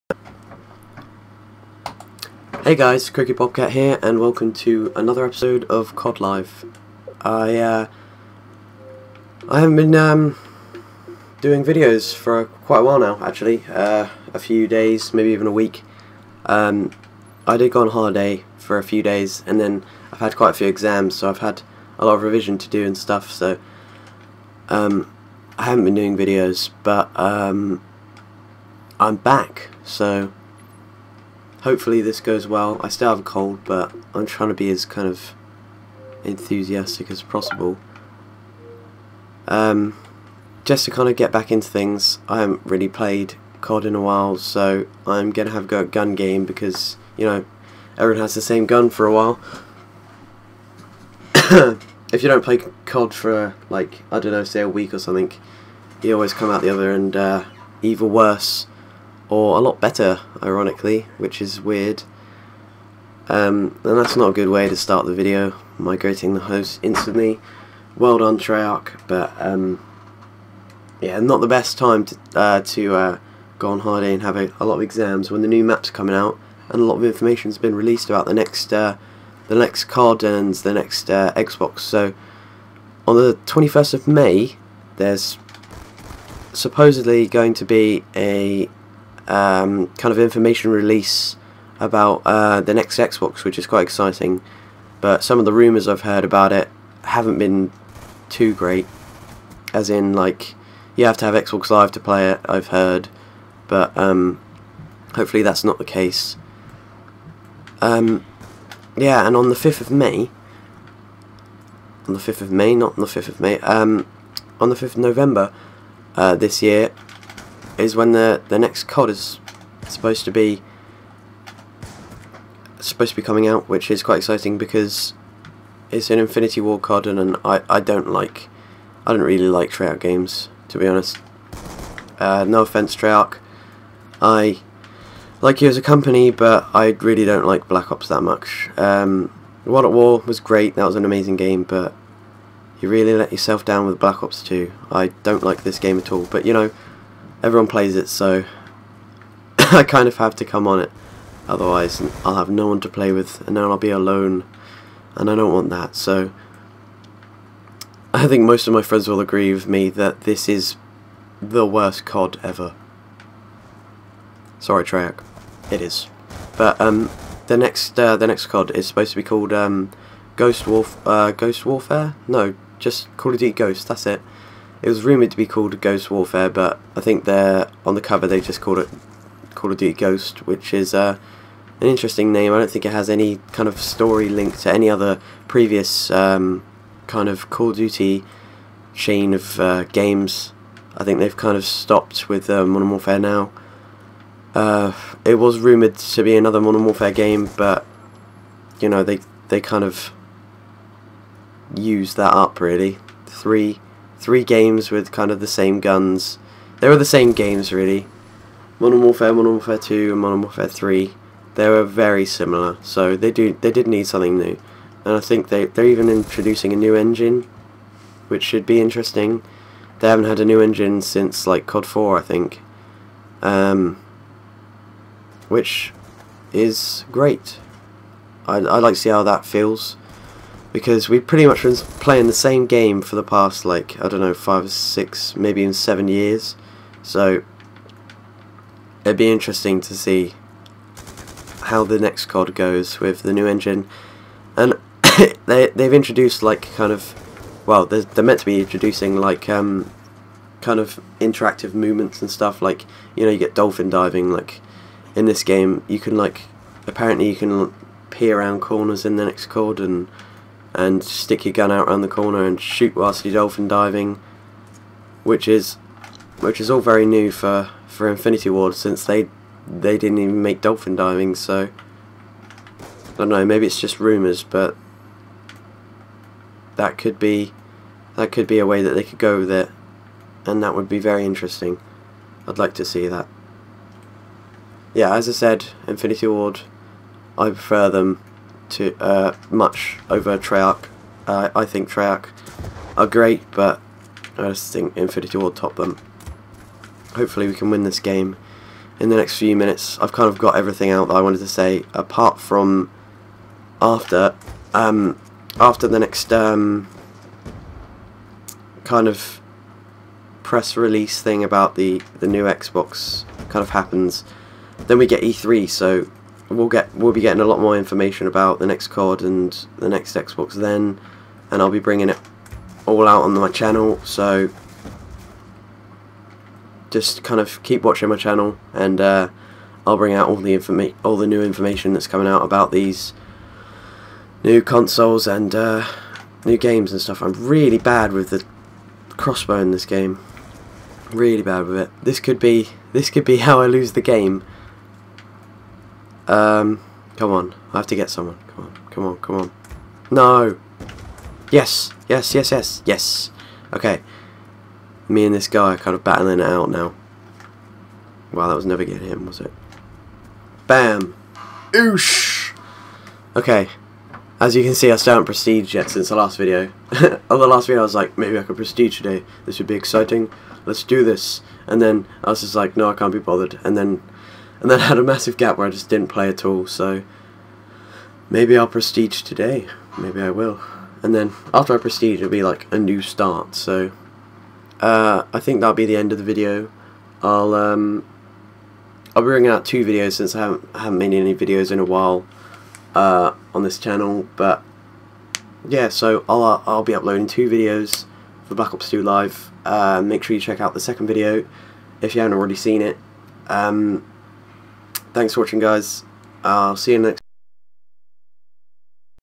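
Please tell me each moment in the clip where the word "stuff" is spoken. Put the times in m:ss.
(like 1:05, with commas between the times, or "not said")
0:22, 4:12, 5:37.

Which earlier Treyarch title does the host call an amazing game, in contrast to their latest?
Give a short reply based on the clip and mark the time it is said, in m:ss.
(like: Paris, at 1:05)
World at War, at 2:19.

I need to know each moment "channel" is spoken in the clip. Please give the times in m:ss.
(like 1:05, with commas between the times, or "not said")
5:23, 5:28, 6:33.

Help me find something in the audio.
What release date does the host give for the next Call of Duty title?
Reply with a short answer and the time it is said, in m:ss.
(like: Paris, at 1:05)
5th of November, at 1:54.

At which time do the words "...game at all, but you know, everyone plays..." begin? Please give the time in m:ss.
2:25.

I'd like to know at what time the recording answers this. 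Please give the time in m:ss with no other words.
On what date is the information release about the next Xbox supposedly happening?
1:23.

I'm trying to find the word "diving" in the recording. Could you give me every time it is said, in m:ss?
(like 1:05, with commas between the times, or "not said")
4:13, 4:23, 4:30.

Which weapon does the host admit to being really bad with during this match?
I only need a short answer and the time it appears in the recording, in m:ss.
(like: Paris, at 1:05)
Crossbow, at 5:39.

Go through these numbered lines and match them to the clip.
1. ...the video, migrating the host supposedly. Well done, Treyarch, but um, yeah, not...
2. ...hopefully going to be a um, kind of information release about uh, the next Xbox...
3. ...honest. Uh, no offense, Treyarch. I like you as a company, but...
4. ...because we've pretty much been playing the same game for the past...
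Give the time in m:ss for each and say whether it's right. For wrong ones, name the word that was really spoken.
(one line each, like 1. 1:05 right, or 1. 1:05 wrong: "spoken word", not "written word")
1. 1:05 wrong: "instantly", not "supposedly"
2. 1:26 wrong: "supposedly", not "hopefully"
3. 2:10 right
4. 3:50 right.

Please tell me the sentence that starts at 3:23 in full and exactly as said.
Three three games with kind of the same guns.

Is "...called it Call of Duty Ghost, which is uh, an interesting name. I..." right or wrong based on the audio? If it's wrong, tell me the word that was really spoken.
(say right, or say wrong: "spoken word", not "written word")
right.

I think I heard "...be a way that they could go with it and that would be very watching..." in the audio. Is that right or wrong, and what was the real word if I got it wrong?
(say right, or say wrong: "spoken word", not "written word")
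wrong: "interesting", not "watching".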